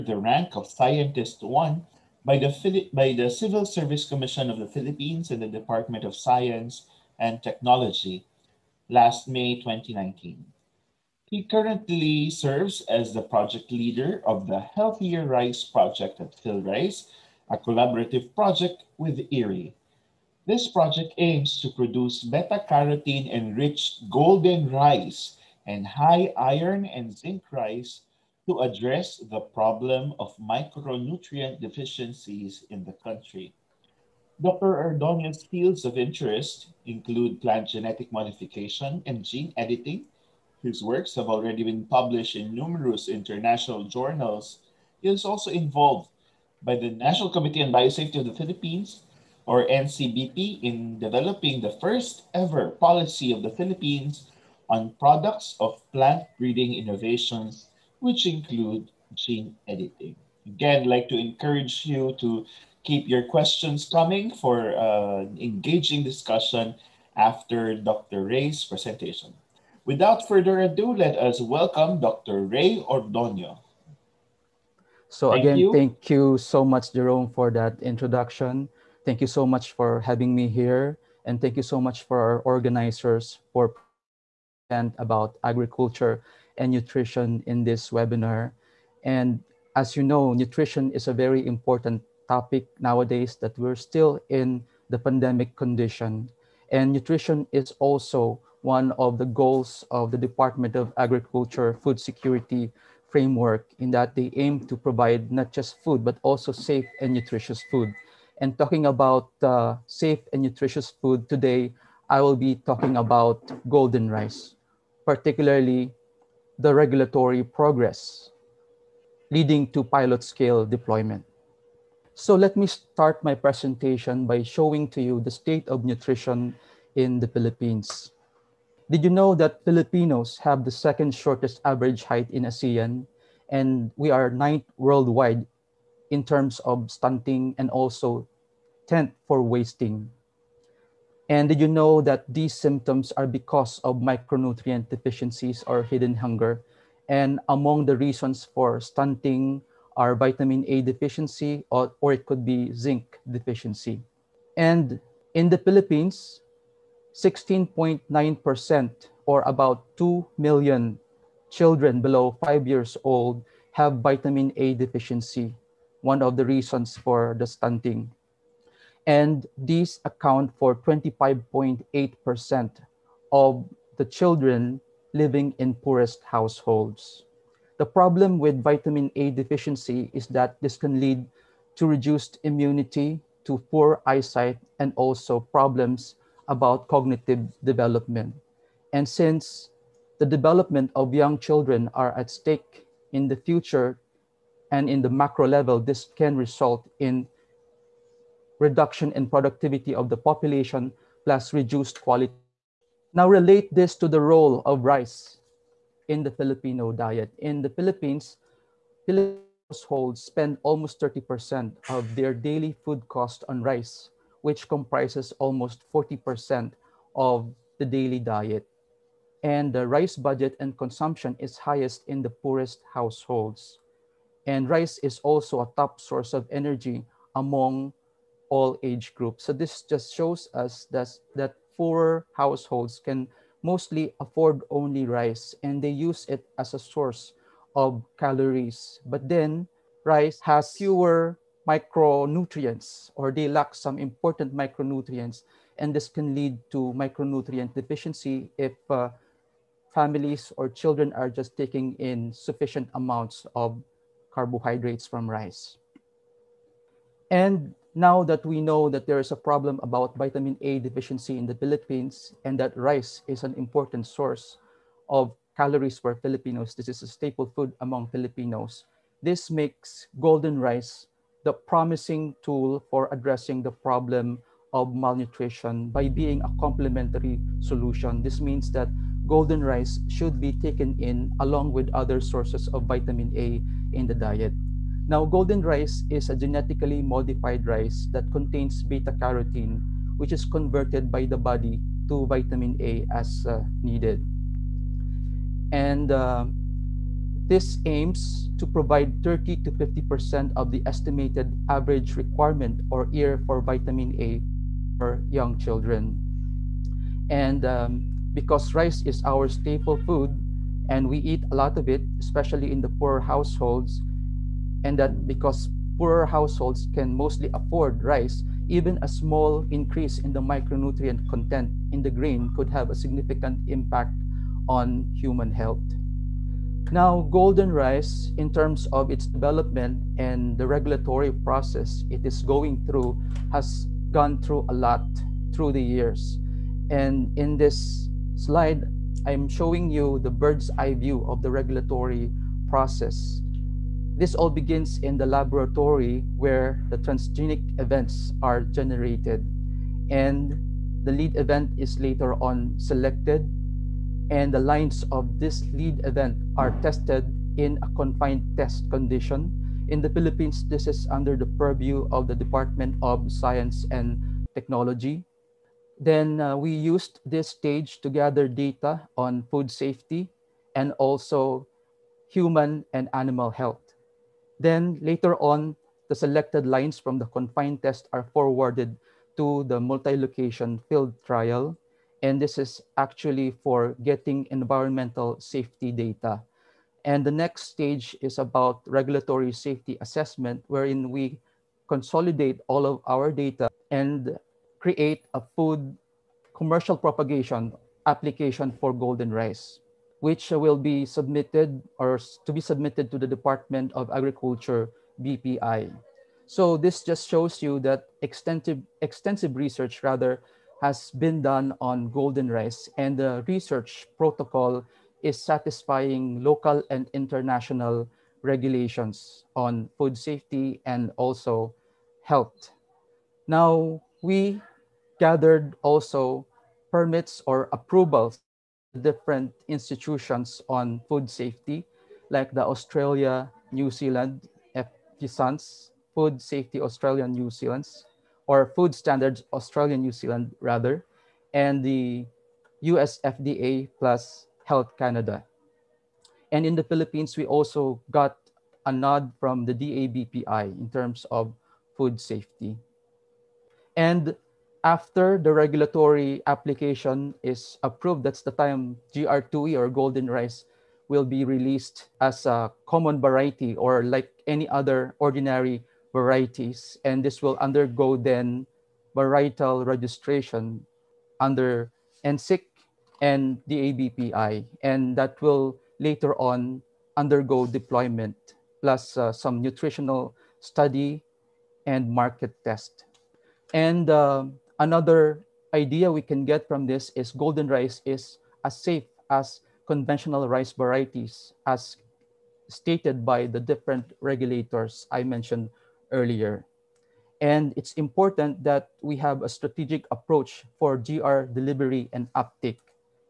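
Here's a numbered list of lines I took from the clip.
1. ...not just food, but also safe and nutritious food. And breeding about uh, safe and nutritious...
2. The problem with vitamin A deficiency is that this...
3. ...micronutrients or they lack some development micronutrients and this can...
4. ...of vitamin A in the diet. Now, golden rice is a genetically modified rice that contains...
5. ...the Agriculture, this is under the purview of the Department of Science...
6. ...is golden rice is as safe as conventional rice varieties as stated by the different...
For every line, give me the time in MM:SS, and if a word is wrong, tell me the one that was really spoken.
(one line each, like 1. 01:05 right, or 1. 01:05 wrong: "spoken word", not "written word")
1. 01:45 wrong: "talking", not "breeding"
2. 02:57 right
3. 04:01 wrong: "important", not "development"
4. 04:42 right
5. 06:00 wrong: "Philippines", not "Agriculture"
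6. 08:07 right.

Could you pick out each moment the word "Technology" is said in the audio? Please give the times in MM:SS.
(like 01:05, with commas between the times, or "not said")
00:07, 06:04.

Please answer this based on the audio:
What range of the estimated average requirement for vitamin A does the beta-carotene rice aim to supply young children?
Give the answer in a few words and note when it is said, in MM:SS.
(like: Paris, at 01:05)
30 to 50%, at 04:59.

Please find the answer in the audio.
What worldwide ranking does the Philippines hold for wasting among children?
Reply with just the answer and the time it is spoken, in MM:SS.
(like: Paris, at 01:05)
10th, at 02:18.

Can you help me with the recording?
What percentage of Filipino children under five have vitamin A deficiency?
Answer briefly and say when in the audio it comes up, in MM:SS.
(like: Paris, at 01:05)
16.9%, at 02:37.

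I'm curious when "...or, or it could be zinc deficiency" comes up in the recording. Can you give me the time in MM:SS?
02:31.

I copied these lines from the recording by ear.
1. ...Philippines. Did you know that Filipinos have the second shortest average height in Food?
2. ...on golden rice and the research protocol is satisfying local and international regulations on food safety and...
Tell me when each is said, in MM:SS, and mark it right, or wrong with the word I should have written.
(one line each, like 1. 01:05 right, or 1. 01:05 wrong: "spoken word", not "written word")
1. 02:07 wrong: "ASEAN", not "Food"
2. 06:51 right.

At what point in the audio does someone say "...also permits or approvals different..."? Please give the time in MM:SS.
07:05.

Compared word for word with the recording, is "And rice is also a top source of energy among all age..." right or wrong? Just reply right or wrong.
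right.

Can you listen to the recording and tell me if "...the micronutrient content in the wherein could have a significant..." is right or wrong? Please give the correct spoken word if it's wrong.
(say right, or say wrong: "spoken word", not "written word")
wrong: "grain", not "wherein".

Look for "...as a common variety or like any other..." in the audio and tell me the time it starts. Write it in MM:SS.
07:42.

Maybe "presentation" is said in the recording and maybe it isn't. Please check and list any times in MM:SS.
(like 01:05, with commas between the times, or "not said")
01:08, 02:03.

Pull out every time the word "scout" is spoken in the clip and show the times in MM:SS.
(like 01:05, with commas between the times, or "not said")
not said.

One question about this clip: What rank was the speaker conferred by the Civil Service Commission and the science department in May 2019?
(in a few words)
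Scientist 1.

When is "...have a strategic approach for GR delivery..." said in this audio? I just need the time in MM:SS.
08:19.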